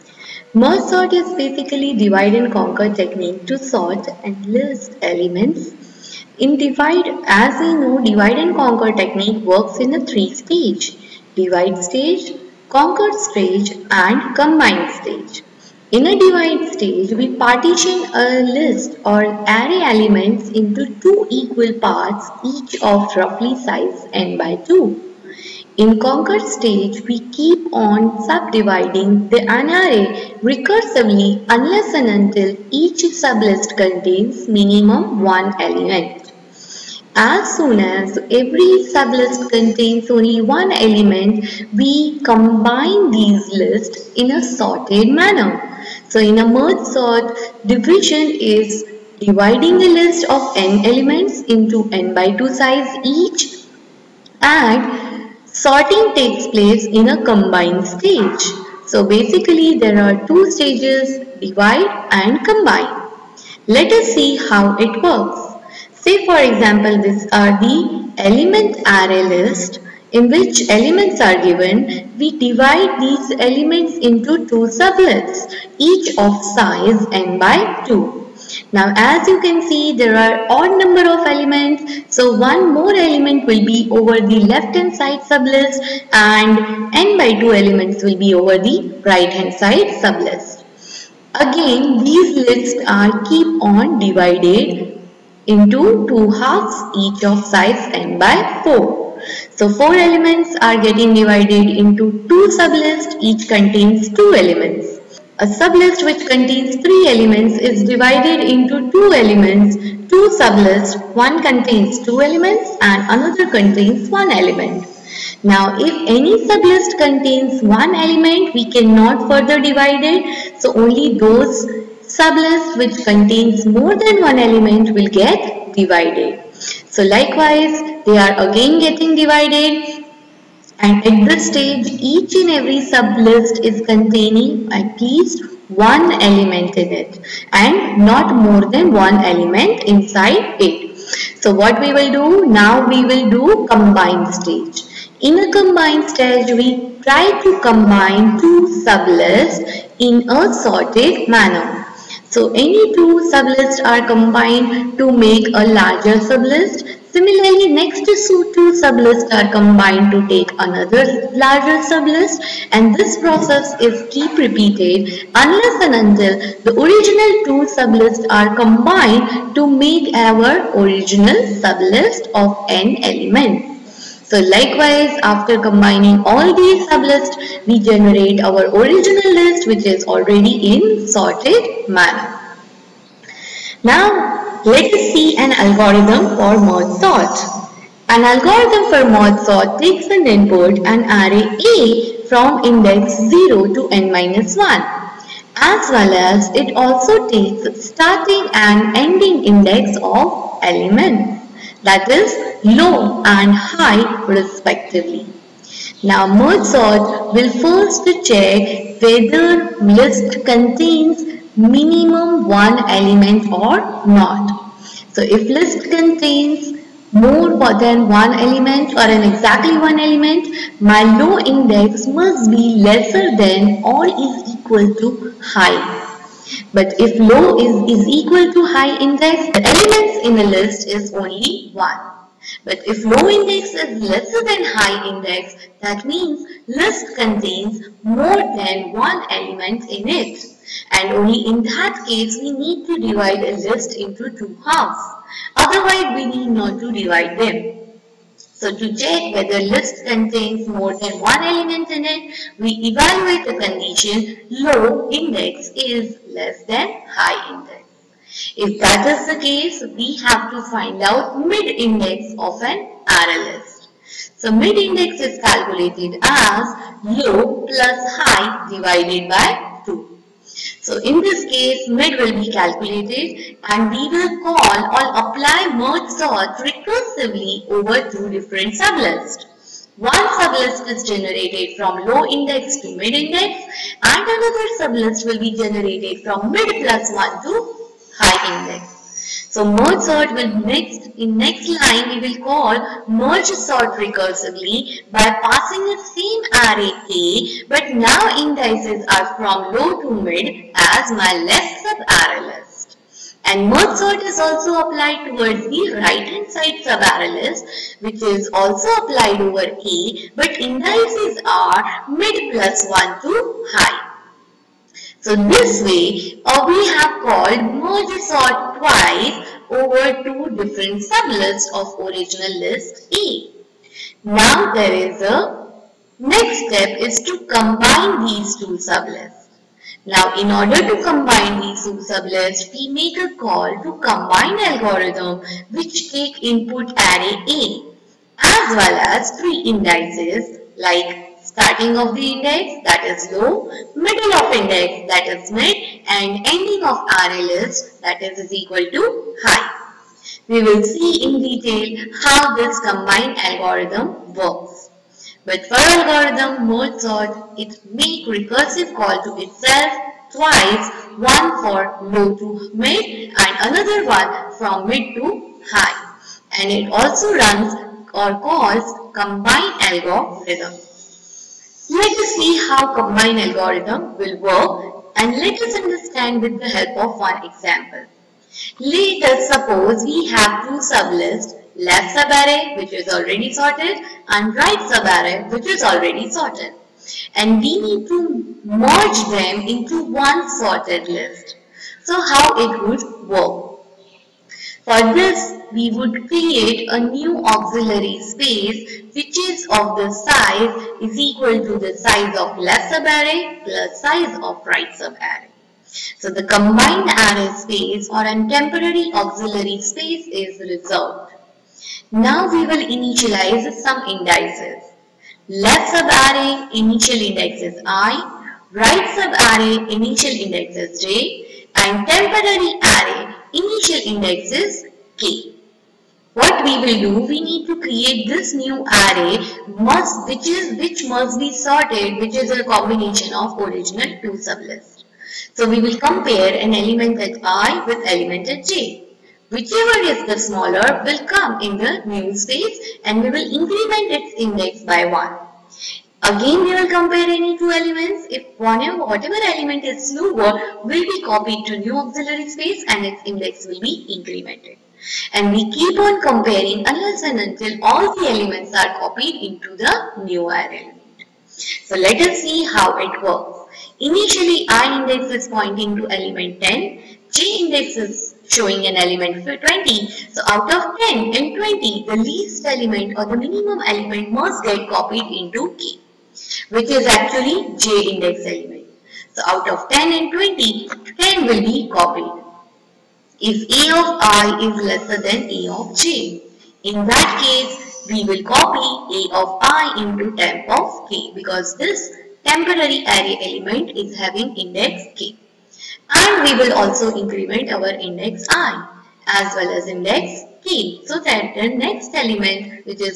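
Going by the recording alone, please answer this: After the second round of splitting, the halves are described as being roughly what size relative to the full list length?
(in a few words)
n by 4.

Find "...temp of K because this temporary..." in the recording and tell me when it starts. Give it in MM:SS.
08:10.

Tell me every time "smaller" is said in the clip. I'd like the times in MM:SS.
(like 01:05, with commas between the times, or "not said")
07:20, 07:30.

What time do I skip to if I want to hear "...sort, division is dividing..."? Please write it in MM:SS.
00:46.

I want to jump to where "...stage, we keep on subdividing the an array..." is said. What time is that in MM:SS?
00:26.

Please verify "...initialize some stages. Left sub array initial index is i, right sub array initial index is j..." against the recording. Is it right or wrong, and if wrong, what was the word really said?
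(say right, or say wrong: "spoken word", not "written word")
wrong: "indices", not "stages".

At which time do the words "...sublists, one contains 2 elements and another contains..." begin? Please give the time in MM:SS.
01:50.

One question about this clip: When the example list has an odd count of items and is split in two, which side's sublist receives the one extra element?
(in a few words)
left hand side.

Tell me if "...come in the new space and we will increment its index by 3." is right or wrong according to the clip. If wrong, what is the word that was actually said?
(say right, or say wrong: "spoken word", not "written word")
wrong: "1", not "3".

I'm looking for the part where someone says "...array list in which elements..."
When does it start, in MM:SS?
01:08.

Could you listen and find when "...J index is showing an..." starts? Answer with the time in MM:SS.
07:47.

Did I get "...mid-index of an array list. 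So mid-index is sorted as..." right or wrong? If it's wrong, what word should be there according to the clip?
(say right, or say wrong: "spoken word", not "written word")
wrong: "calculated", not "sorted".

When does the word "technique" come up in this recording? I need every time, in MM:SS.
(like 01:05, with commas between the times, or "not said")
00:03, 00:08.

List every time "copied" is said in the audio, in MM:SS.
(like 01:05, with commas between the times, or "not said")
07:31, 07:38, 07:54, 08:01.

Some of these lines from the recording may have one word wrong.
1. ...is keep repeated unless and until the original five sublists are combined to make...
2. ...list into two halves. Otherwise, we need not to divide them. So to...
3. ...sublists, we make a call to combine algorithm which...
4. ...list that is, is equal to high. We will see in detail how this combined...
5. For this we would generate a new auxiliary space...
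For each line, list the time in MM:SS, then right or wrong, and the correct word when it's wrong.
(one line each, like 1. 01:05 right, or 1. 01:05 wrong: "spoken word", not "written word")
1. 02:43 wrong: "two", not "five"
2. 04:03 right
3. 05:31 right
4. 05:47 right
5. 06:34 wrong: "create", not "generate".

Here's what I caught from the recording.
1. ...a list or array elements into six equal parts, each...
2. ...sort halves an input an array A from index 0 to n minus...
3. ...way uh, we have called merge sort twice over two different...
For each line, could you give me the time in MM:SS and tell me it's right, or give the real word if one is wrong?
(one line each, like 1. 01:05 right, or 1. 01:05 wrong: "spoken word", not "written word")
1. 00:18 wrong: "two", not "six"
2. 03:09 wrong: "takes", not "halves"
3. 05:15 right.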